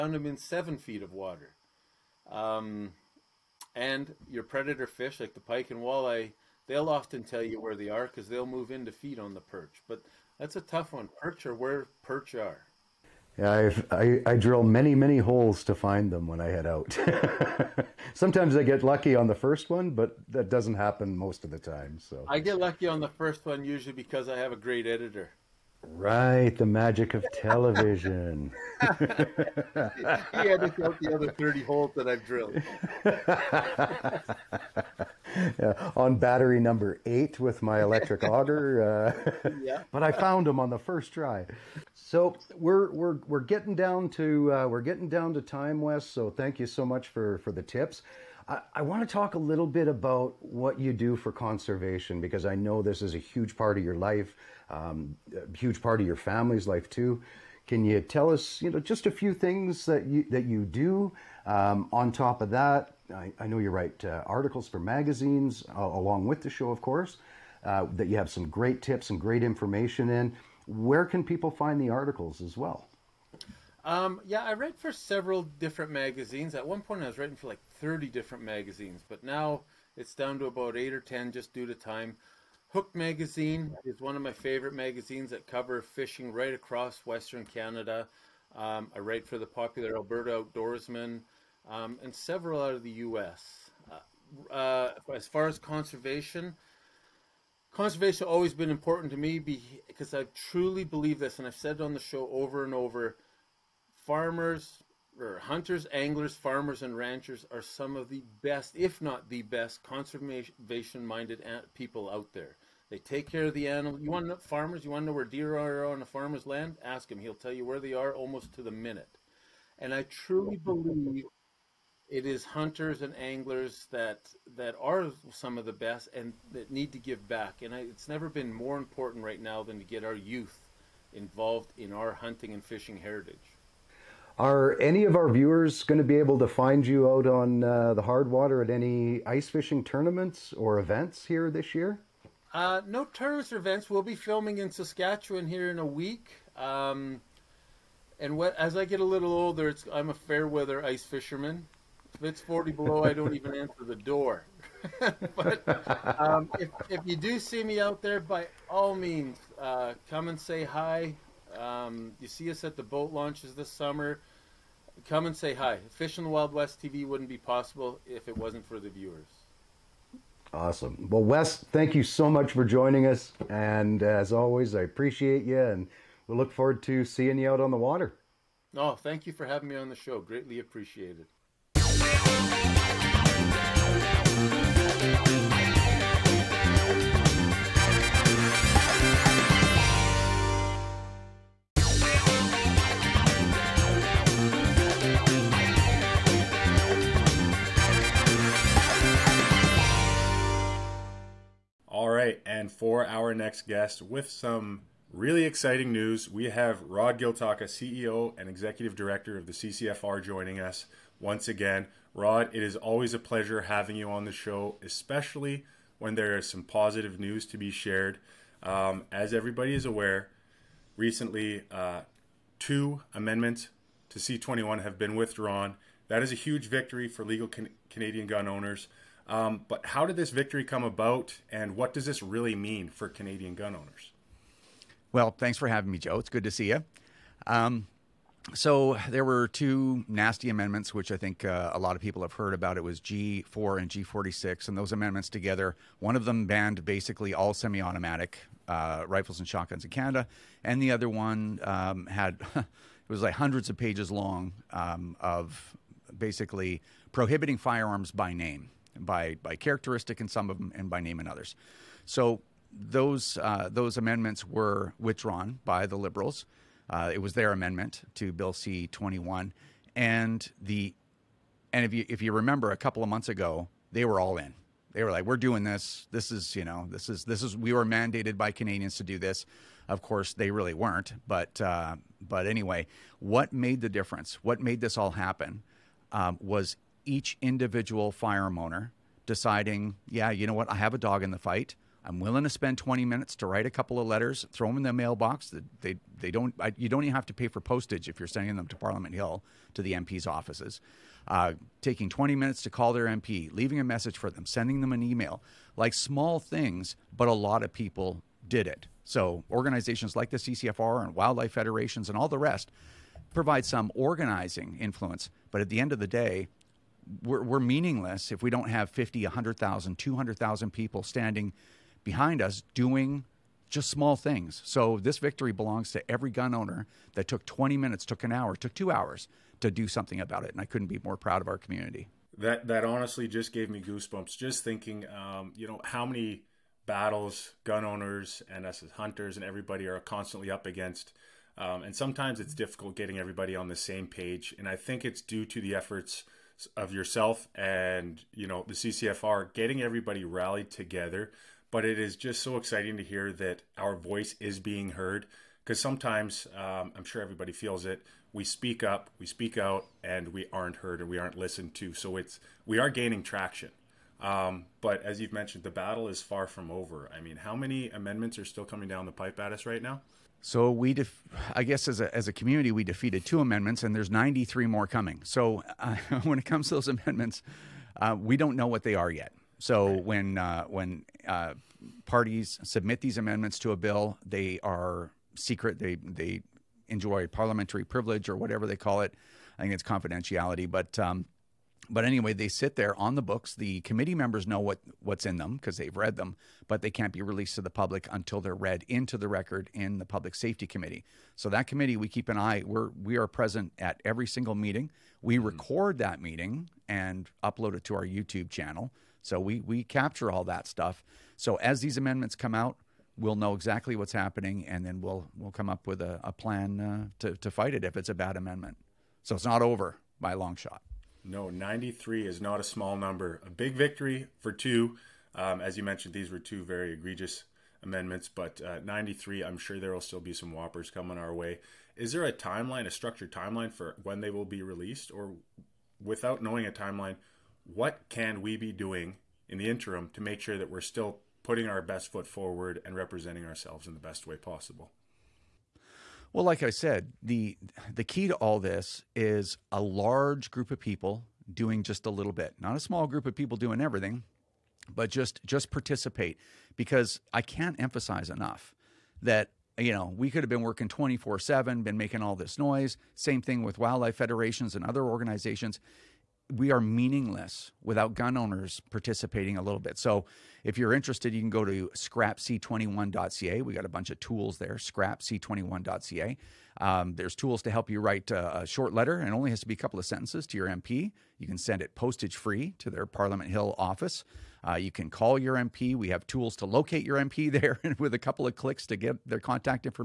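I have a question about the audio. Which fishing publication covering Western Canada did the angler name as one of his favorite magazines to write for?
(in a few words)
Hooked Magazine.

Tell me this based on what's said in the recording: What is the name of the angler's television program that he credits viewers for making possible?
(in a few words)
Fishing the Wild West TV.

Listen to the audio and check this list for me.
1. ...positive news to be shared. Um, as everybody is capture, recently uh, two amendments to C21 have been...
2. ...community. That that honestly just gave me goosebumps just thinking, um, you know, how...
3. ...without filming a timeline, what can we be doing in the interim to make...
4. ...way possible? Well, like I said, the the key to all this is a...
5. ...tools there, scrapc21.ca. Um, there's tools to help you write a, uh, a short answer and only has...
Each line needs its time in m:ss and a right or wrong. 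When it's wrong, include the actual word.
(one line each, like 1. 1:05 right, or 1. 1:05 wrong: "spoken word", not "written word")
1. 3:36 wrong: "aware", not "capture"
2. 5:31 right
3. 7:16 wrong: "knowing", not "filming"
4. 7:24 right
5. 7:54 wrong: "letter", not "answer".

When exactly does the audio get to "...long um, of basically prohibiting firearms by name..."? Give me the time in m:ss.
4:14.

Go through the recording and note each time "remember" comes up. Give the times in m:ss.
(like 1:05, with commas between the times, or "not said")
4:32.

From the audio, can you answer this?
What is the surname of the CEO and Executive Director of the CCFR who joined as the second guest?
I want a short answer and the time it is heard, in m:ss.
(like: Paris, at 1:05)
Giltaca, at 3:27.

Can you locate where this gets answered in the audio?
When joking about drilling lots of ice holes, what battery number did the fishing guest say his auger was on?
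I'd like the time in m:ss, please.
0:36.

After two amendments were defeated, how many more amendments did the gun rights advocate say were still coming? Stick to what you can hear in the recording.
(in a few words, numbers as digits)
93.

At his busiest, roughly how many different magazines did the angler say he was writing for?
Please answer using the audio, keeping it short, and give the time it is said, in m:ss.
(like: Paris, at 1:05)
30, at 1:17.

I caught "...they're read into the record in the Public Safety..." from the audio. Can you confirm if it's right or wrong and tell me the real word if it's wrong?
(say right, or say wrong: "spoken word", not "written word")
right.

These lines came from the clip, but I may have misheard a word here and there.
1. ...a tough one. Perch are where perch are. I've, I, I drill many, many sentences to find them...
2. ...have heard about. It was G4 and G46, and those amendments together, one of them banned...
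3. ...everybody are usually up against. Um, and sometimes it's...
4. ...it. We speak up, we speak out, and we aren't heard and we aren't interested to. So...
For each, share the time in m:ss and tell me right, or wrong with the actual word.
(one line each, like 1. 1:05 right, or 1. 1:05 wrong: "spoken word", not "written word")
1. 0:10 wrong: "holes", not "sentences"
2. 4:02 right
3. 5:39 wrong: "constantly", not "usually"
4. 5:57 wrong: "listened", not "interested".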